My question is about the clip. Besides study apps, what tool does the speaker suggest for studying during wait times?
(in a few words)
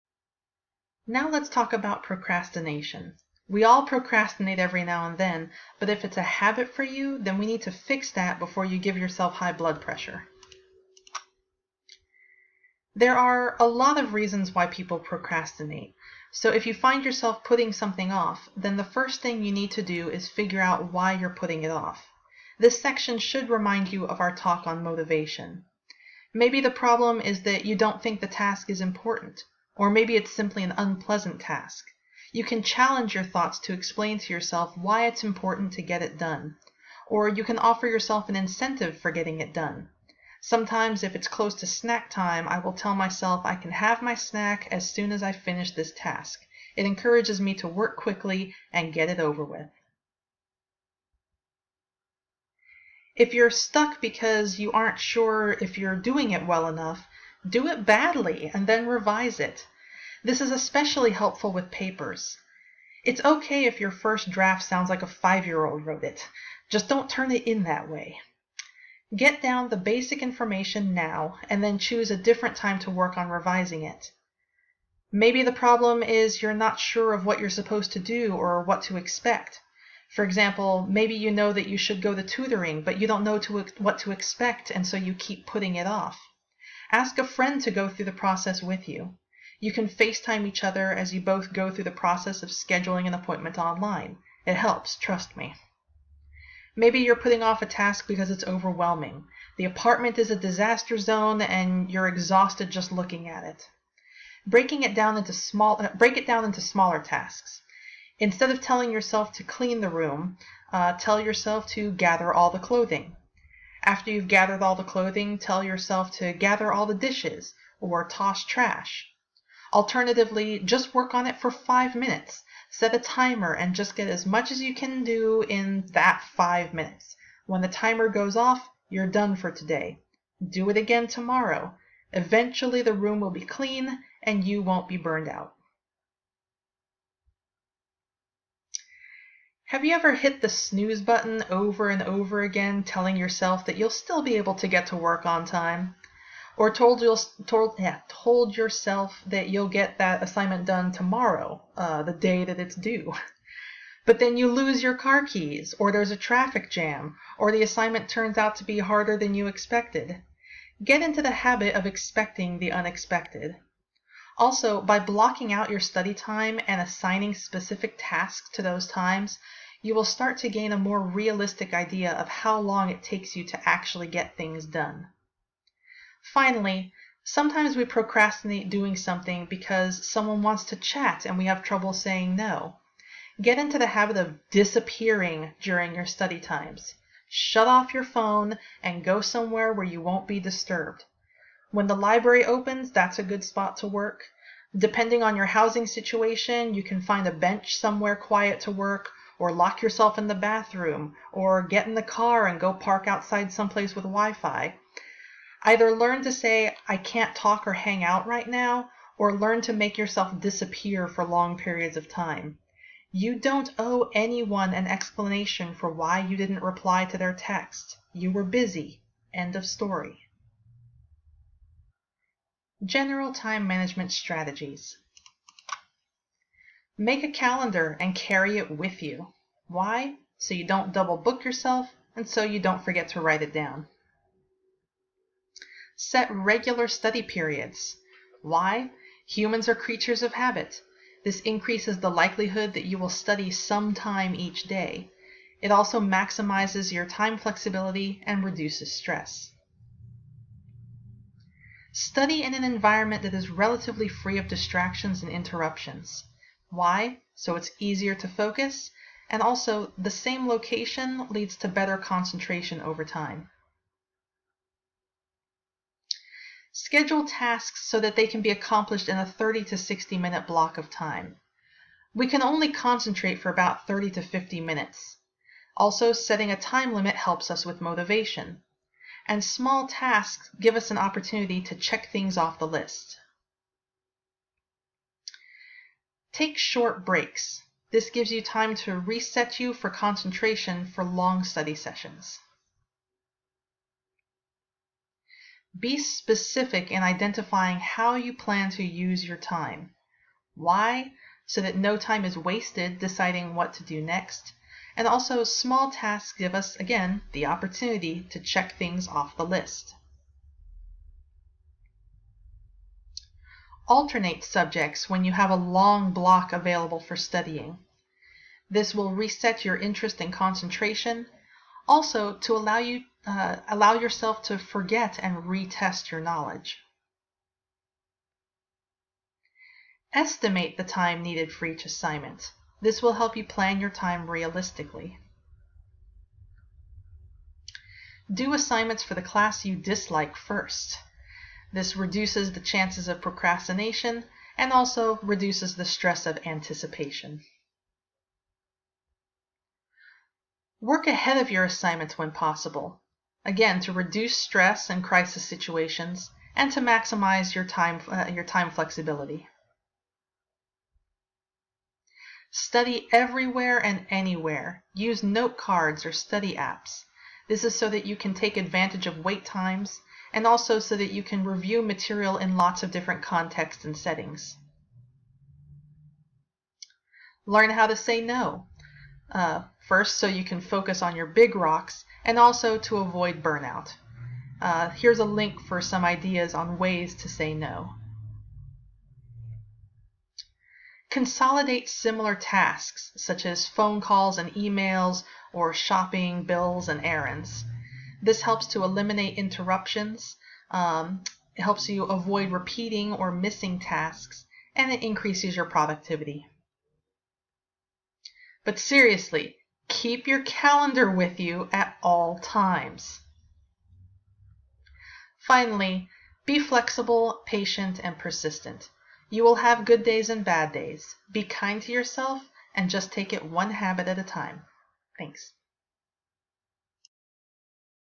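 note cards.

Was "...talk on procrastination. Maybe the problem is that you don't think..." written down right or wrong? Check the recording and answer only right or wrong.
wrong.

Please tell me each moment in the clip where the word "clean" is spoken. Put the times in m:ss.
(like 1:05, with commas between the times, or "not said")
1:49, 2:13.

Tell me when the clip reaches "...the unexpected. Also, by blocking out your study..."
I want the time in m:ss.
2:42.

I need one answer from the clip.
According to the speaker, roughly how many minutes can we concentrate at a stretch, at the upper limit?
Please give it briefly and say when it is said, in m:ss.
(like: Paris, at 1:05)
50, at 4:34.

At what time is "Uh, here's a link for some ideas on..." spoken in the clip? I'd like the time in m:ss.
6:24.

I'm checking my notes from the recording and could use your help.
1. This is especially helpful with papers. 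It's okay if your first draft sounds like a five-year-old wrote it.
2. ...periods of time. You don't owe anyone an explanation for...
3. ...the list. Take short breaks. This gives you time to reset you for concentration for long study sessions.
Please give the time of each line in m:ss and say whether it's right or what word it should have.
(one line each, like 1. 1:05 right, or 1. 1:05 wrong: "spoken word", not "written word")
1. 1:00 right
2. 3:31 right
3. 4:42 right.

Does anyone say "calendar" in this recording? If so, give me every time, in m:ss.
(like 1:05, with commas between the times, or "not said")
3:47, 6:50.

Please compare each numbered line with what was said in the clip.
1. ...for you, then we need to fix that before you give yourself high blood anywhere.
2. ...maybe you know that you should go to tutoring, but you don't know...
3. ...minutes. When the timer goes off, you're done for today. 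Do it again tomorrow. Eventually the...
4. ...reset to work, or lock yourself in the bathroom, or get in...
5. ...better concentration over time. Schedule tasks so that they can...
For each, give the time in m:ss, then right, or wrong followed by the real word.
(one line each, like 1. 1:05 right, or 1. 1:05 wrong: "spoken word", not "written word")
1. 0:06 wrong: "pressure", not "anywhere"
2. 1:20 right
3. 2:06 right
4. 3:18 wrong: "quiet", not "reset"
5. 4:21 right.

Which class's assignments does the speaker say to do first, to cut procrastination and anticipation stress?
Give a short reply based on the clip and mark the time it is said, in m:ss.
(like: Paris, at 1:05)
the class you dislike, at 5:39.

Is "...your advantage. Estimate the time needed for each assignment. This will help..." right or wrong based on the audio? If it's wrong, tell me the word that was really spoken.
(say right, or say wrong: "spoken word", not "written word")
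wrong: "knowledge", not "advantage".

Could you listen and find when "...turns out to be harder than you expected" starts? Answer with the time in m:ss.
2:38.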